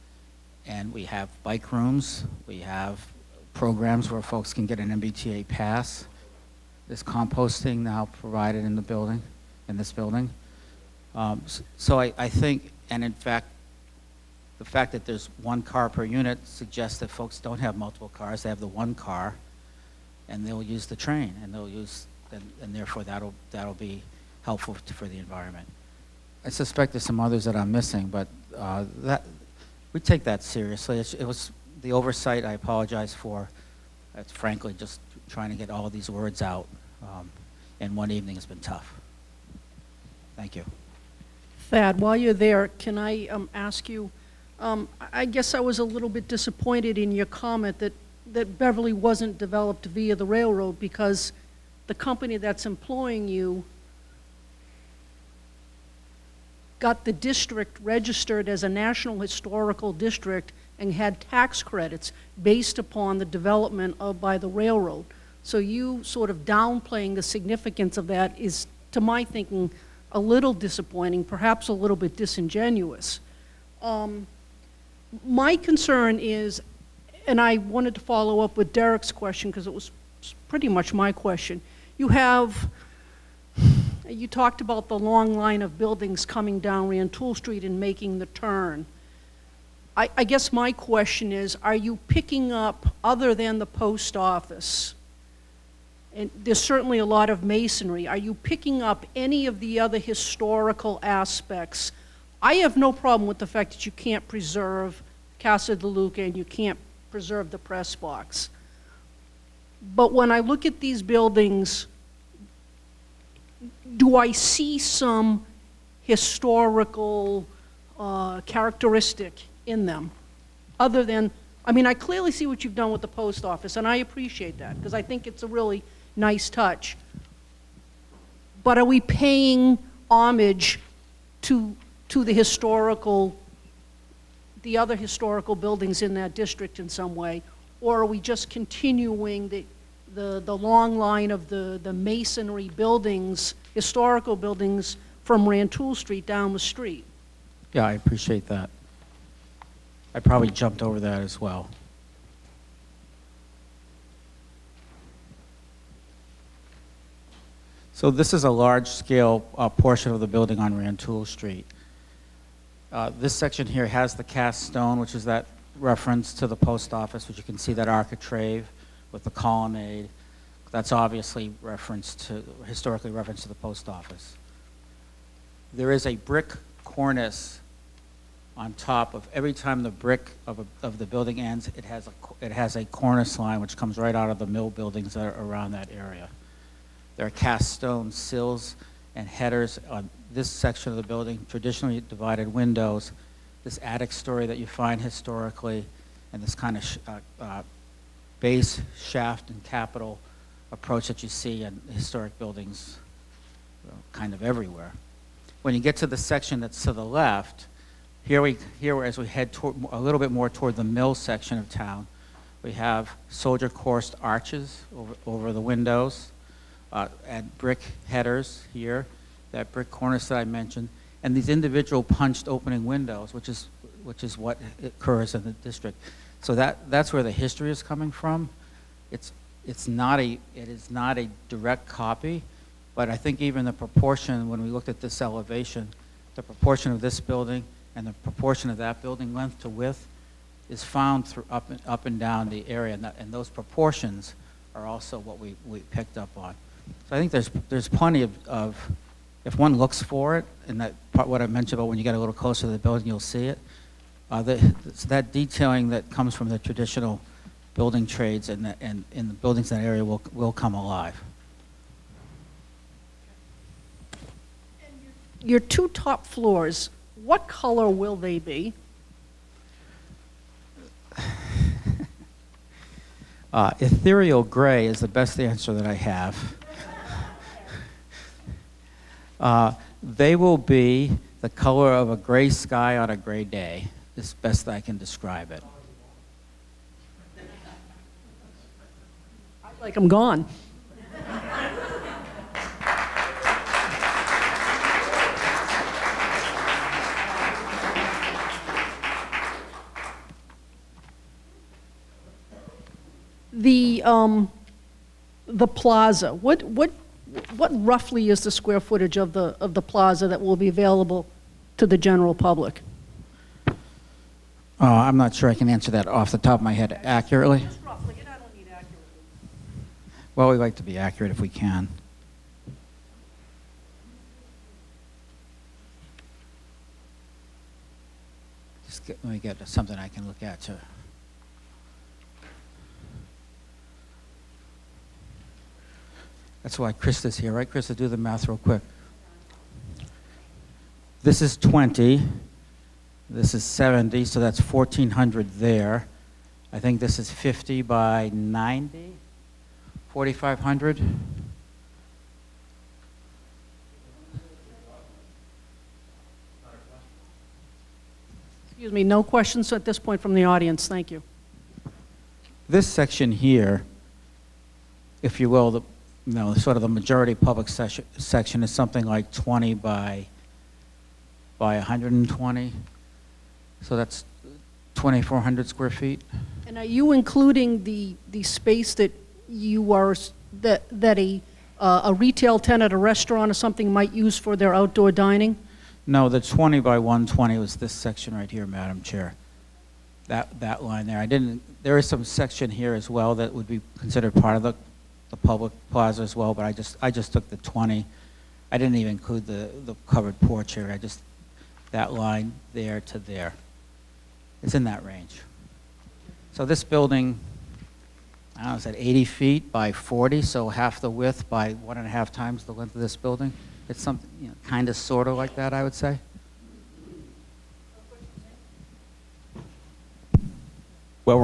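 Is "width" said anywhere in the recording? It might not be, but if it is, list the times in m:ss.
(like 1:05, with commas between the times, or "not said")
3:59, 6:51.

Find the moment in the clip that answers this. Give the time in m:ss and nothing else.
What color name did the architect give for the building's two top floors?
4:33.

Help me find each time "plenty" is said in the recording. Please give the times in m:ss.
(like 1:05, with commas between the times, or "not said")
4:07.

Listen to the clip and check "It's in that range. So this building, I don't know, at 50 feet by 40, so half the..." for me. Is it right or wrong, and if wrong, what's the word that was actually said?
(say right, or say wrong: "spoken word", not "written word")
wrong: "80", not "50".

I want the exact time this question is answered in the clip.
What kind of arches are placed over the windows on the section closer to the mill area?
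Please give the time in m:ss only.
3:33.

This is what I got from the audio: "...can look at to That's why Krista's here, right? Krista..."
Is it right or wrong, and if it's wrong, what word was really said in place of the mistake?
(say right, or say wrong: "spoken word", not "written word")
right.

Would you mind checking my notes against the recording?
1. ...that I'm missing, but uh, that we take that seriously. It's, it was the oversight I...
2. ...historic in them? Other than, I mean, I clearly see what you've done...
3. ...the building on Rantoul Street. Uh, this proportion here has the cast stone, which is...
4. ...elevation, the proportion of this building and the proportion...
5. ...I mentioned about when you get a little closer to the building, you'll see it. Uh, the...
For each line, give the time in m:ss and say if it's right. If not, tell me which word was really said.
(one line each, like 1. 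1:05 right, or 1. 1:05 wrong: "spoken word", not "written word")
1. 0:27 right
2. 1:58 wrong: "characteristic", not "historic"
3. 2:40 wrong: "section", not "proportion"
4. 3:55 right
5. 4:11 right.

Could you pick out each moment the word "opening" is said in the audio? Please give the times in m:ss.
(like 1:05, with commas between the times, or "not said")
3:42.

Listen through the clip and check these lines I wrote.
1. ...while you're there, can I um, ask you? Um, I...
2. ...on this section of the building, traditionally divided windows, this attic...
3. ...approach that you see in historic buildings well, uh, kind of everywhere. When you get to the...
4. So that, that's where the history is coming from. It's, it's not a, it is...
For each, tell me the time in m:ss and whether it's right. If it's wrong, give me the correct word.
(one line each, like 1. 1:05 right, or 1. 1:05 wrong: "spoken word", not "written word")
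1. 0:42 right
2. 3:09 right
3. 3:20 right
4. 3:46 right.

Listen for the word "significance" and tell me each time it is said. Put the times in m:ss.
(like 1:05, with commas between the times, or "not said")
1:07.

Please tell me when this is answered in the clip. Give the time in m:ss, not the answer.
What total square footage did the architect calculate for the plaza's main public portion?
6:14.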